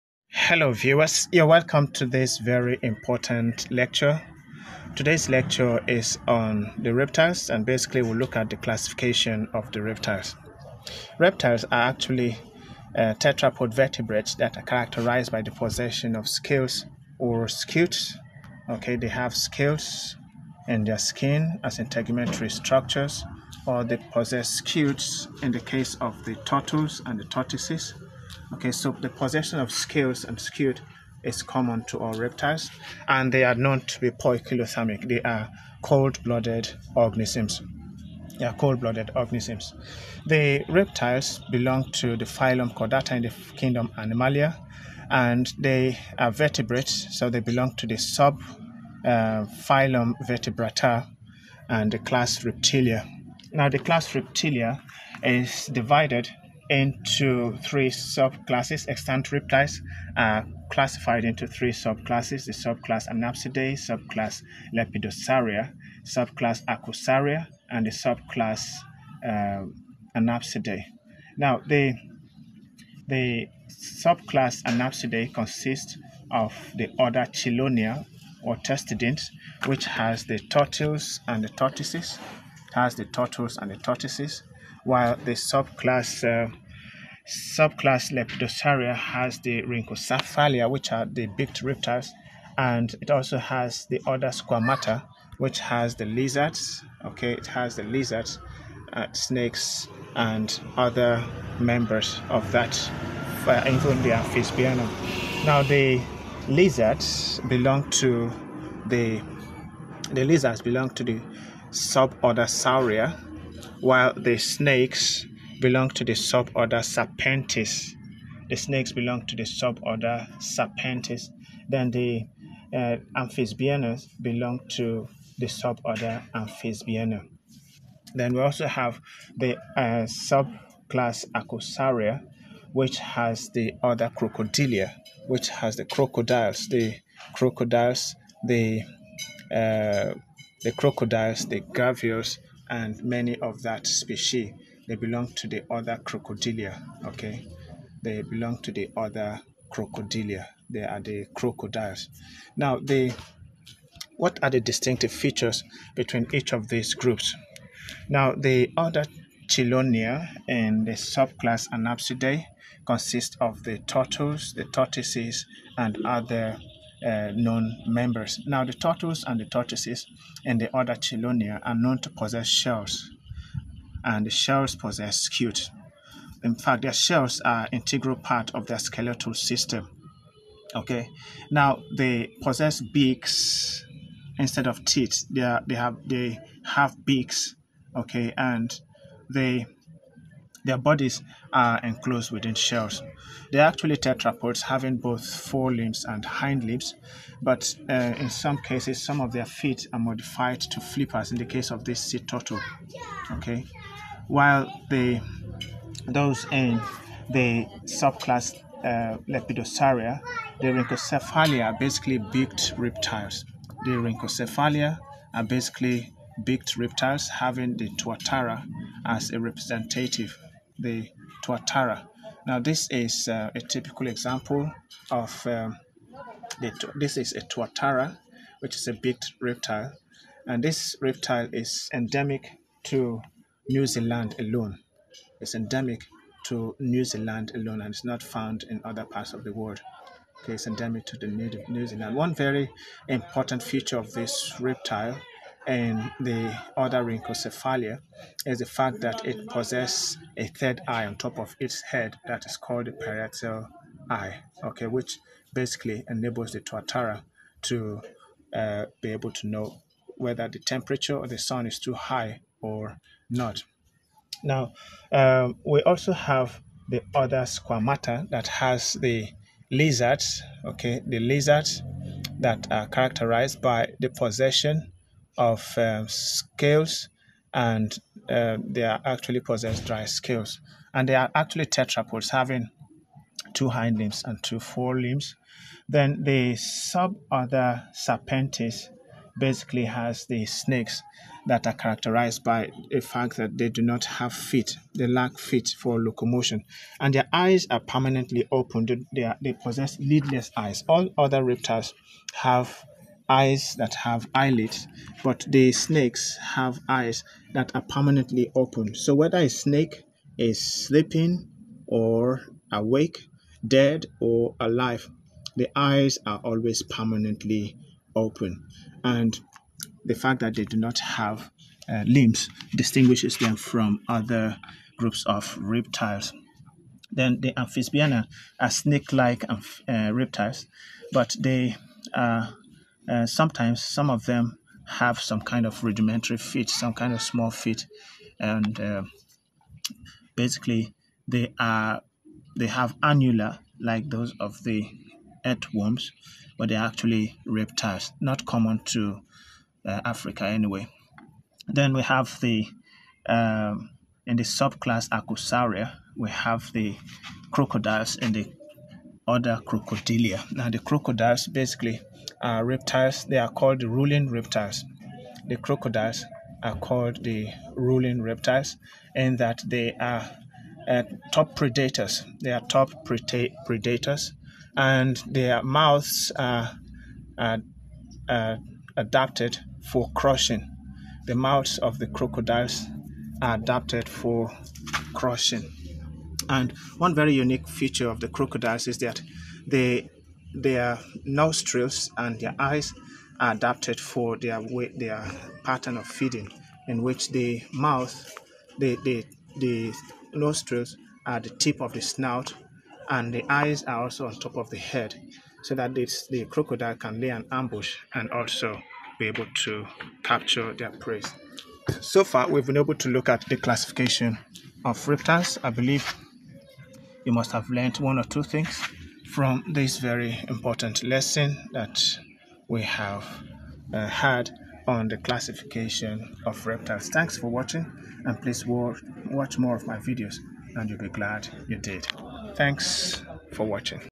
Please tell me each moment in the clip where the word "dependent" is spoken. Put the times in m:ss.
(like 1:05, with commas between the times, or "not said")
not said.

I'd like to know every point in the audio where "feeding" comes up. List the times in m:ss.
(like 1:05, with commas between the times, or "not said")
6:36.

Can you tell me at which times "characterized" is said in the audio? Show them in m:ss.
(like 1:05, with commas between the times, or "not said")
0:14, 4:32, 4:51.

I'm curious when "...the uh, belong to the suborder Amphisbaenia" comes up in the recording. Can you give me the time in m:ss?
2:01.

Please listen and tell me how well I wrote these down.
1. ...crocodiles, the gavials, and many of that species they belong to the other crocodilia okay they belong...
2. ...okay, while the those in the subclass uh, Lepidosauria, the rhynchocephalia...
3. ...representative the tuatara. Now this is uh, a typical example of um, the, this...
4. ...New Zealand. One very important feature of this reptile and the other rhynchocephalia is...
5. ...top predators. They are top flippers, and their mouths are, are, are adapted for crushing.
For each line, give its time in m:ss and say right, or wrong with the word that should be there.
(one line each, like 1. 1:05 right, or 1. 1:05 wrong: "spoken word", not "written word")
1. 2:20 right
2. 3:23 right
3. 3:39 right
4. 4:01 right
5. 6:11 wrong: "predators", not "flippers".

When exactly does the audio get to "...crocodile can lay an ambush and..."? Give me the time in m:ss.
6:46.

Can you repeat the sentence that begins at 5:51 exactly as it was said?
Then we have the um, in the subclass Archosauria, we have the crocodiles and the other crocodilia.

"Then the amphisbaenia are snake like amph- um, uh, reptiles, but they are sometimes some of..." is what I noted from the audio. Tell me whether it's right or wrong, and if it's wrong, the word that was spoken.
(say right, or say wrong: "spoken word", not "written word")
right.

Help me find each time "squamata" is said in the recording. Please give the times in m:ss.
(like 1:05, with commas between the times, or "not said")
1:34, 4:27.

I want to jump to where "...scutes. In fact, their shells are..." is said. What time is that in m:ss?
2:55.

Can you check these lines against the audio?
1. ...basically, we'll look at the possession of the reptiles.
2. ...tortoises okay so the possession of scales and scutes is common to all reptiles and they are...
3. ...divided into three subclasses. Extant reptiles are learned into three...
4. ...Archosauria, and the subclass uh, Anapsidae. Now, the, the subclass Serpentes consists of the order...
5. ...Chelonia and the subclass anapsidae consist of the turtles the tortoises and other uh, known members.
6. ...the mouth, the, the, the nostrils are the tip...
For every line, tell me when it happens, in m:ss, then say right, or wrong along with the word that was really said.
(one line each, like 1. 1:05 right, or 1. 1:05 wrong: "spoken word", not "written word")
1. 0:07 wrong: "classification", not "possession"
2. 0:27 right
3. 0:55 wrong: "classified", not "learned"
4. 1:06 wrong: "Anapsidae", not "Serpentes"
5. 2:39 right
6. 6:37 right.